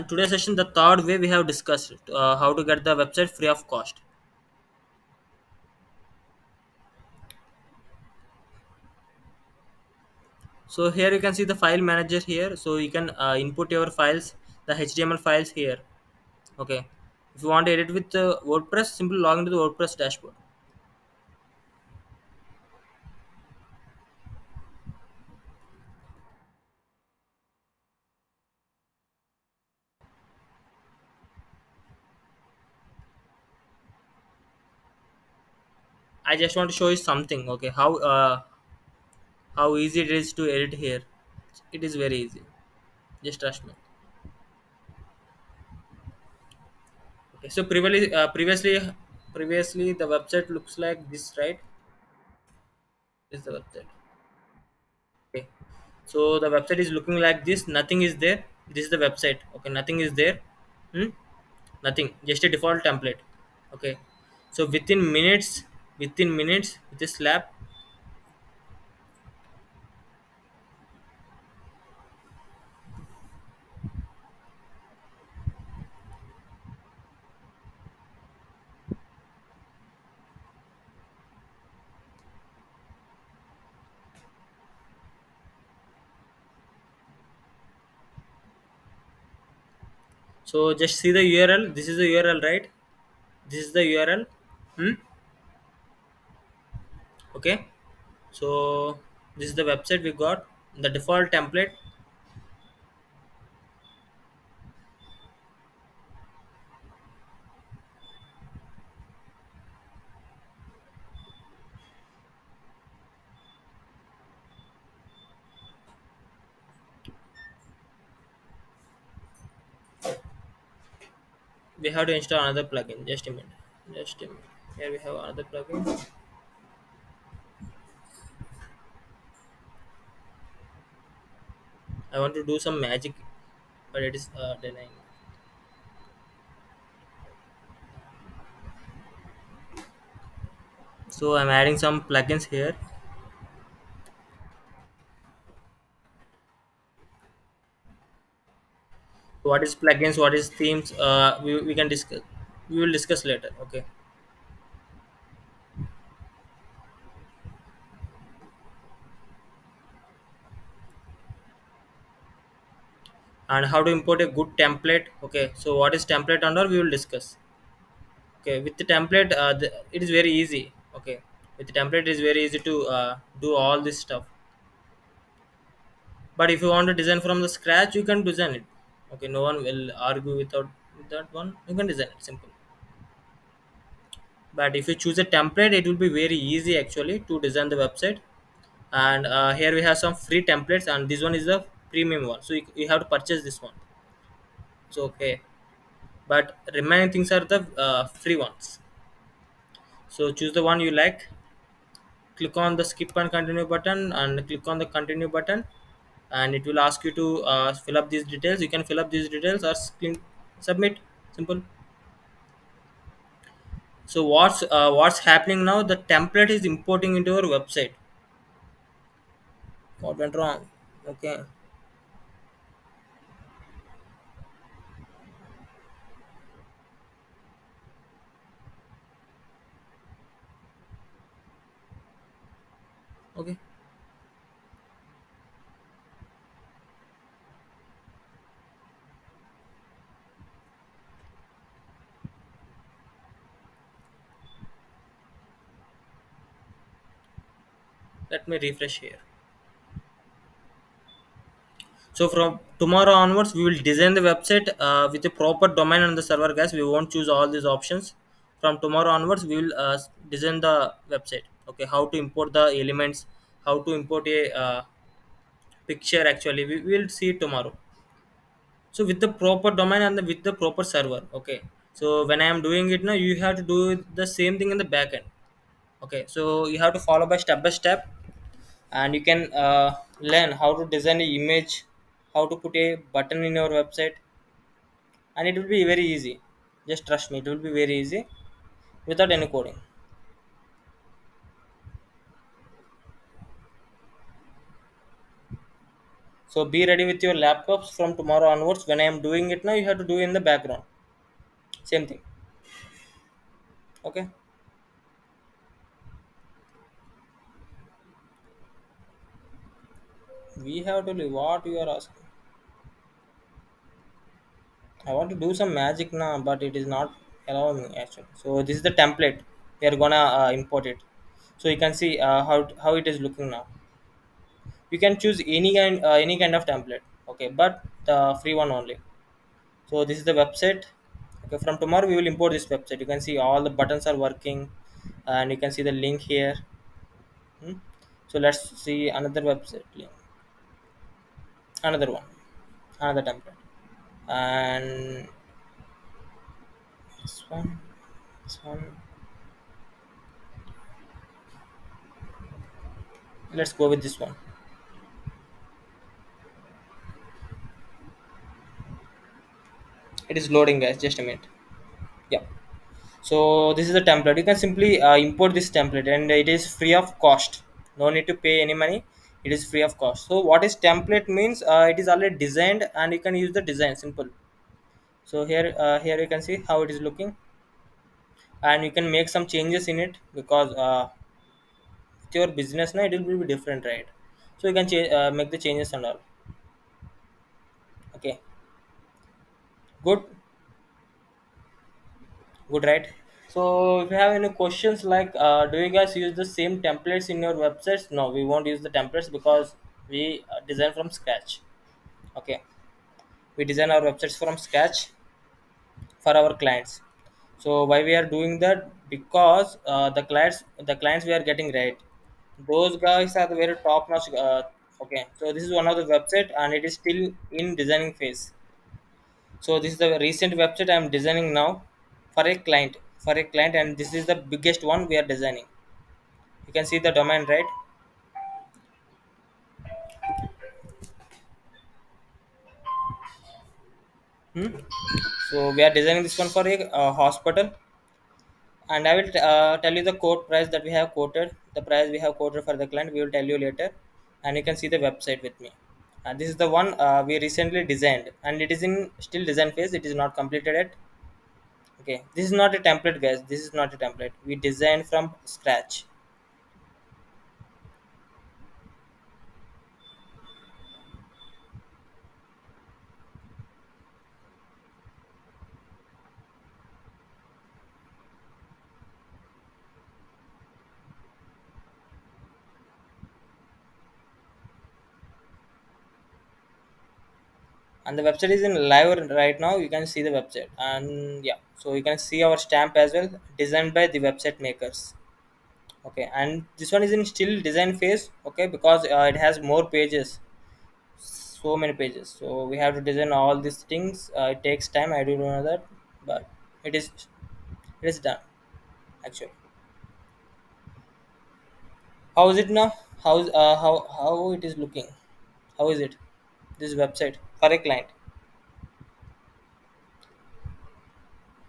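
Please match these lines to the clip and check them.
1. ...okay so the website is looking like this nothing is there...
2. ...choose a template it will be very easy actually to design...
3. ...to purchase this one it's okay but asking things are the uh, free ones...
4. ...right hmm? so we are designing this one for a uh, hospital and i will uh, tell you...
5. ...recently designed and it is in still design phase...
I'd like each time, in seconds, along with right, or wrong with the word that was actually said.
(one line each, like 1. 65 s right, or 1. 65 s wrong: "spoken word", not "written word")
1. 55 s right
2. 184 s right
3. 193 s wrong: "remaining", not "asking"
4. 427 s right
5. 447 s right.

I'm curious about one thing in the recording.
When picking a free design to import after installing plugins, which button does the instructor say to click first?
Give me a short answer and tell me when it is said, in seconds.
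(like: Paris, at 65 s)
skip and continue, at 202 s.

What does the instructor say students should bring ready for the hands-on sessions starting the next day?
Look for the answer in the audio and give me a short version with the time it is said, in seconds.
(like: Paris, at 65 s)
laptops, at 297 s.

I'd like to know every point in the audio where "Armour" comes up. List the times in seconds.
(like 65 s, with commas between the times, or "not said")
not said.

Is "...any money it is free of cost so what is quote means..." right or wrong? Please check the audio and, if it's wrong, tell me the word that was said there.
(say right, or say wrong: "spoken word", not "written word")
wrong: "template", not "quote".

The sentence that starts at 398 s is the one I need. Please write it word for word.
No, we won't use the templates because we uh, design from scratch.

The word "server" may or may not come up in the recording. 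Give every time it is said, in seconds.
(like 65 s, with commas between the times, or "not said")
256 s, 270 s.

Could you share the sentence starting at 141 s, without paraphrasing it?
So I'm adding some plugins here.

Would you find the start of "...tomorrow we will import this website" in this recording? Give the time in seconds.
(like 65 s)
331 s.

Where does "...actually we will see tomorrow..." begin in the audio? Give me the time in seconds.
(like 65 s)
266 s.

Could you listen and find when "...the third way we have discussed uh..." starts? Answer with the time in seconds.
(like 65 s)
0 s.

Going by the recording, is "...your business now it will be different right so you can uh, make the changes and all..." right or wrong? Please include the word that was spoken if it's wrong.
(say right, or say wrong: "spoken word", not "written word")
right.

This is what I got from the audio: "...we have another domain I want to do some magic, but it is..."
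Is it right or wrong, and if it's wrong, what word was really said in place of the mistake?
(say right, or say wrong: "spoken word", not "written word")
wrong: "plugin", not "domain".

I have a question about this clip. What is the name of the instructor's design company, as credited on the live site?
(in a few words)
The Website Makers.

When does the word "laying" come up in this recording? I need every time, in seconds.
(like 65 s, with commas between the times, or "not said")
not said.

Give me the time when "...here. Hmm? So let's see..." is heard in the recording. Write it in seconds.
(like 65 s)
336 s.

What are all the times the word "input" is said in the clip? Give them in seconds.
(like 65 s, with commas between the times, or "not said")
13 s.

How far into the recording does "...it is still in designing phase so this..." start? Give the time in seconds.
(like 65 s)
416 s.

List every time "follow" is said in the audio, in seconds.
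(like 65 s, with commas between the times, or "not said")
277 s.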